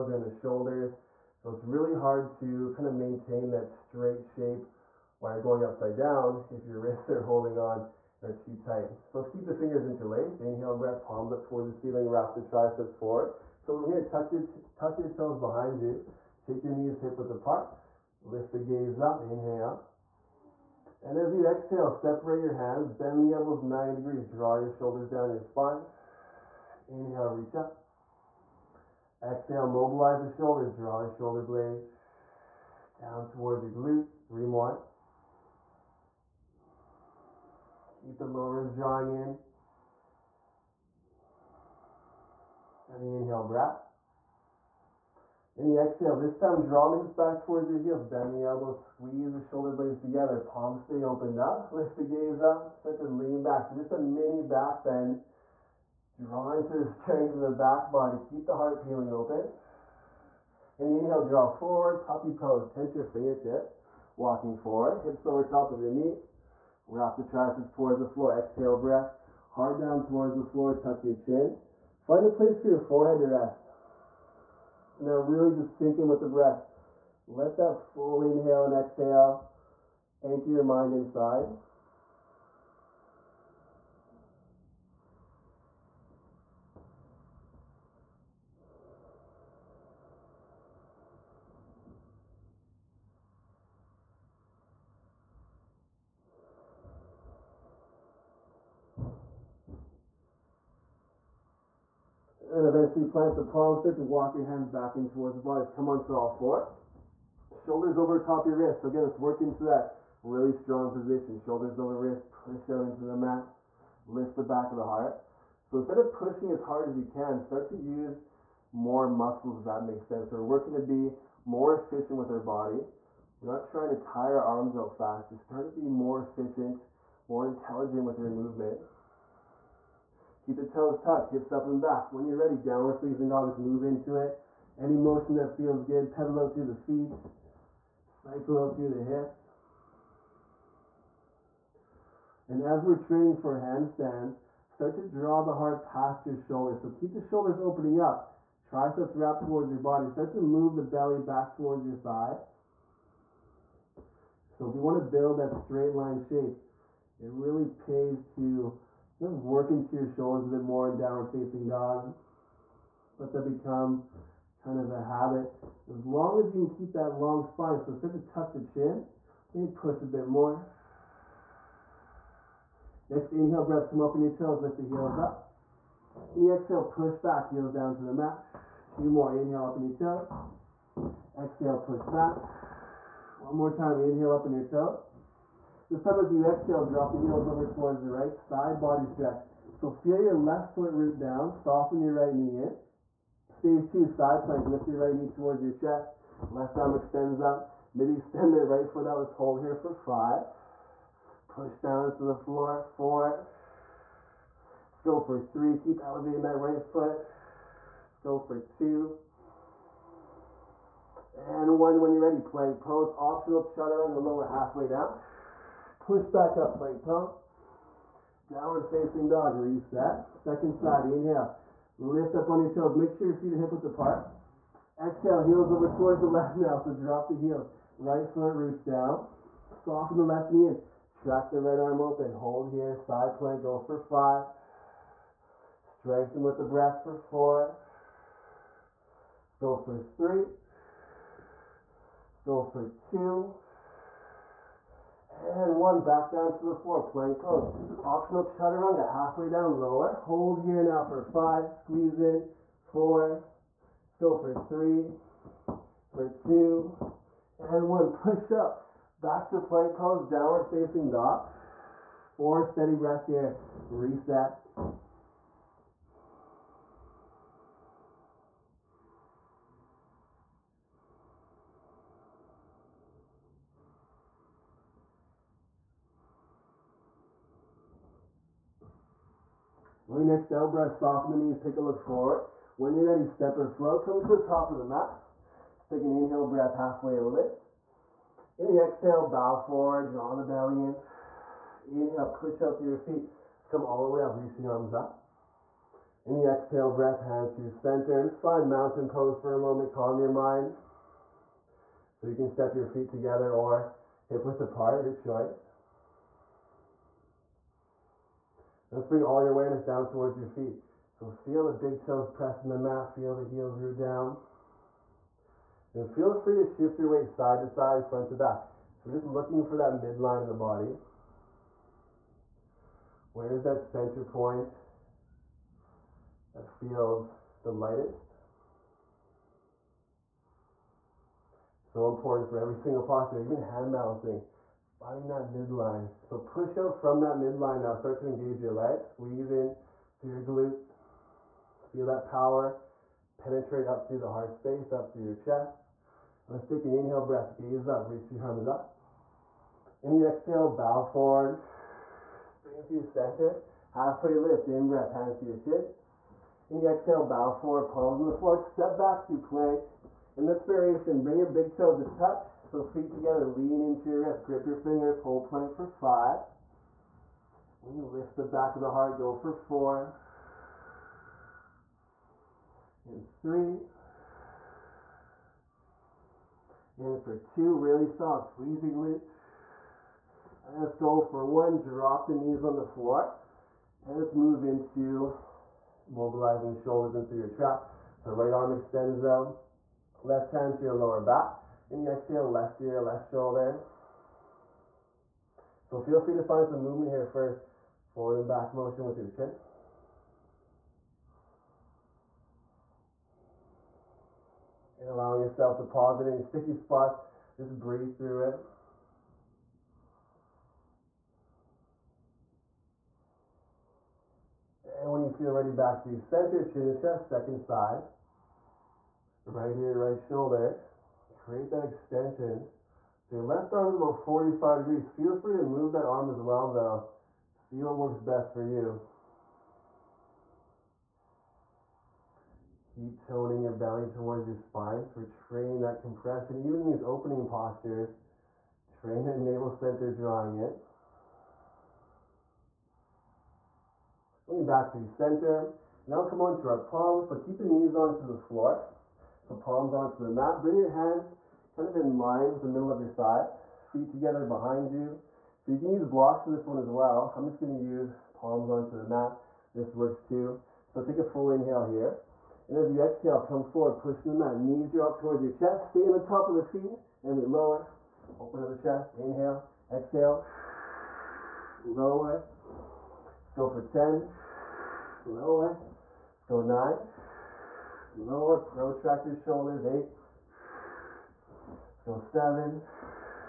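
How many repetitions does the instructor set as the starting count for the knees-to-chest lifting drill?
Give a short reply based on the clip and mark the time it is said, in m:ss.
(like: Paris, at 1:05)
10, at 7:53.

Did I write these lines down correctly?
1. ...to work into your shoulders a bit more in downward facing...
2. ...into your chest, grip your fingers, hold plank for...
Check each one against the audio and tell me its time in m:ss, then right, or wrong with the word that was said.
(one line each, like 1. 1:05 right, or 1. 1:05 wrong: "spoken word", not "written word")
1. 2:38 right
2. 6:03 wrong: "wrist", not "chest".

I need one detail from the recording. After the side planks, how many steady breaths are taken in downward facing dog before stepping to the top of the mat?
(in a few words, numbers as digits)
4.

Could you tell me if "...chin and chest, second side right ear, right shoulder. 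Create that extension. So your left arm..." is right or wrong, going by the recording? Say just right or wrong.
right.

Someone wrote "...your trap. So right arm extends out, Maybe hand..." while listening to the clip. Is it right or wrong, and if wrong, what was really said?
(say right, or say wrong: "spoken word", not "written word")
wrong: "Left", not "Maybe".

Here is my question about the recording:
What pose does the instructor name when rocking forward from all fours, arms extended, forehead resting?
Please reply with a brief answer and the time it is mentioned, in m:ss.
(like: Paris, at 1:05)
puppy pose, at 1:02.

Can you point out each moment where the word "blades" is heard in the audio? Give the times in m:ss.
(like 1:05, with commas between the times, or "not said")
0:31, 0:49.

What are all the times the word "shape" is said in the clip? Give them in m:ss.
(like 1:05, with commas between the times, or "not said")
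0:04, 2:36.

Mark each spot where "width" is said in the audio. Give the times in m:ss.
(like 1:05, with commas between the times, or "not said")
0:17, 3:43, 5:04.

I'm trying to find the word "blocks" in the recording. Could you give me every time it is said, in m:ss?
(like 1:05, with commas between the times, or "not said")
7:36.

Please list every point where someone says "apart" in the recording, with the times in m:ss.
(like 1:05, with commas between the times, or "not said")
0:17, 3:43, 5:04.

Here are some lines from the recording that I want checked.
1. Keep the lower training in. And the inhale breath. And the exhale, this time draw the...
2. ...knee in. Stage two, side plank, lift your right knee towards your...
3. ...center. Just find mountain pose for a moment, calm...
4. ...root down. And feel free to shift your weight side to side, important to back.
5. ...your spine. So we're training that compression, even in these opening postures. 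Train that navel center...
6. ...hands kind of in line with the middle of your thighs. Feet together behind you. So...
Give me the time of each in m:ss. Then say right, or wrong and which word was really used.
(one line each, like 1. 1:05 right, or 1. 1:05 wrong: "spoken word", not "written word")
1. 0:38 wrong: "drawing", not "training"
2. 3:12 right
3. 4:57 right
4. 5:13 wrong: "front", not "important"
5. 7:14 right
6. 7:30 right.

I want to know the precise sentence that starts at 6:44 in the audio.
And allowing yourself to pause in any sticky spots.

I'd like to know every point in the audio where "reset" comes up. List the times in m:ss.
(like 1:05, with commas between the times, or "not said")
3:39, 4:23.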